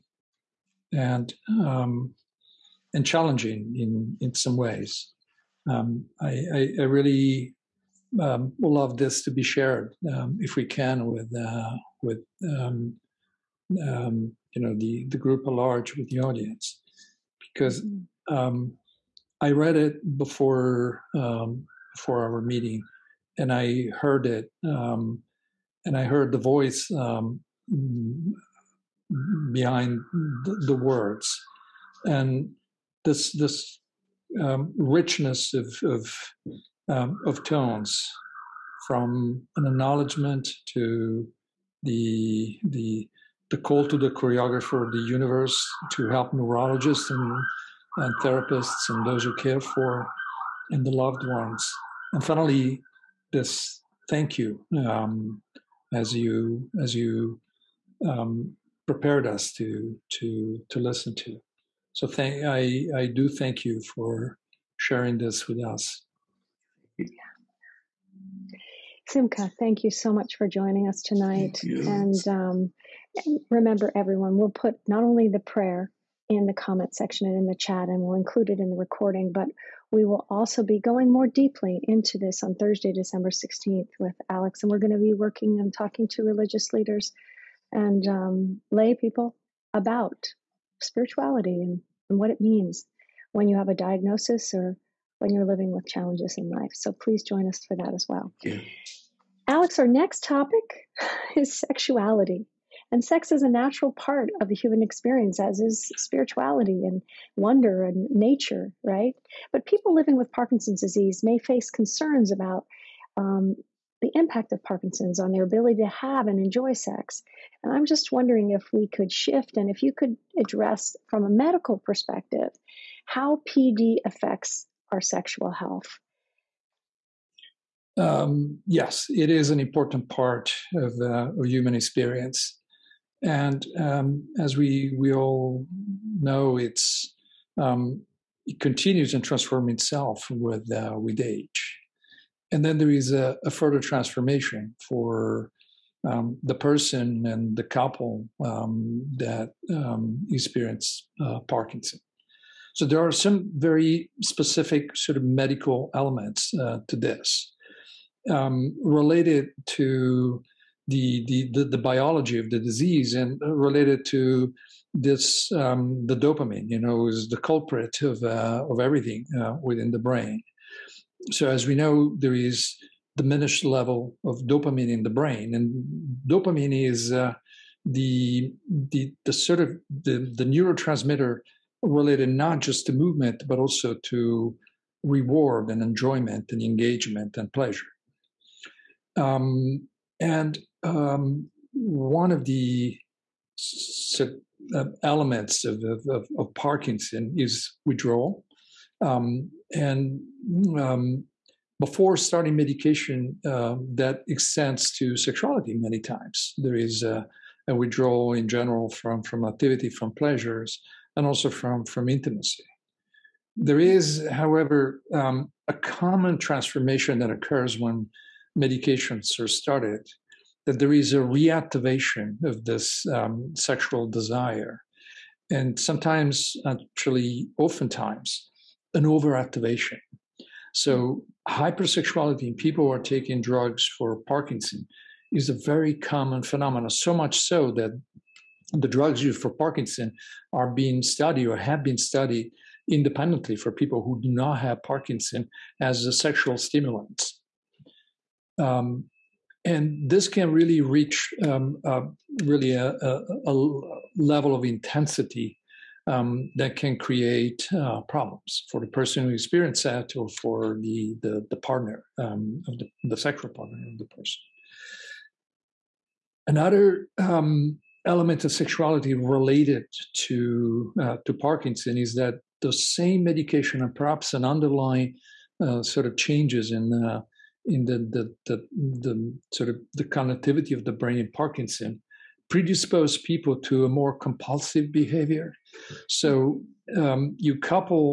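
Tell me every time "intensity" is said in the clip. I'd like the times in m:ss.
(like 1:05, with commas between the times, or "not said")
4:14.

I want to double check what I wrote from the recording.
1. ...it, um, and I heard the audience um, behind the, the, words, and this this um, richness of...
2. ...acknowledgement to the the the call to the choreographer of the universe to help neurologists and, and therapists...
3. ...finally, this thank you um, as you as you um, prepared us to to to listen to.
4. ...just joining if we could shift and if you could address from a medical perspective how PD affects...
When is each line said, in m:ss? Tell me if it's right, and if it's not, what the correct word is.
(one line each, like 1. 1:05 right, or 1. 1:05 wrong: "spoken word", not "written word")
1. 0:24 wrong: "voice", not "audience"
2. 0:39 right
3. 0:52 right
4. 1:57 wrong: "wondering", not "joining".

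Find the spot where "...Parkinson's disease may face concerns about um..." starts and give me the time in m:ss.
1:50.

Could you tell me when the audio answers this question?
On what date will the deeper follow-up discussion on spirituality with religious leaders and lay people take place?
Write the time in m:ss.
1:22.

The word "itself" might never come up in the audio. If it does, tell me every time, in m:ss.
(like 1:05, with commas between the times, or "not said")
2:19.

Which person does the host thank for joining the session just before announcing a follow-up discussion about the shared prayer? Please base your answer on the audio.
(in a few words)
Simkha.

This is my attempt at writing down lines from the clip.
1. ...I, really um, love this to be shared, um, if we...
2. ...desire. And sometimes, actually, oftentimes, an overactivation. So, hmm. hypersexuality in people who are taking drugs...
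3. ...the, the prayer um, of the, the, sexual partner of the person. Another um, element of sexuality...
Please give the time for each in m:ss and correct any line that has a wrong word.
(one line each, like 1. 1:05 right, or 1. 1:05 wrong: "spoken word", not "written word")
1. 0:06 right
2. 3:44 right
3. 4:21 wrong: "partner", not "prayer".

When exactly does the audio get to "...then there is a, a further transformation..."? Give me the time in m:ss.
2:22.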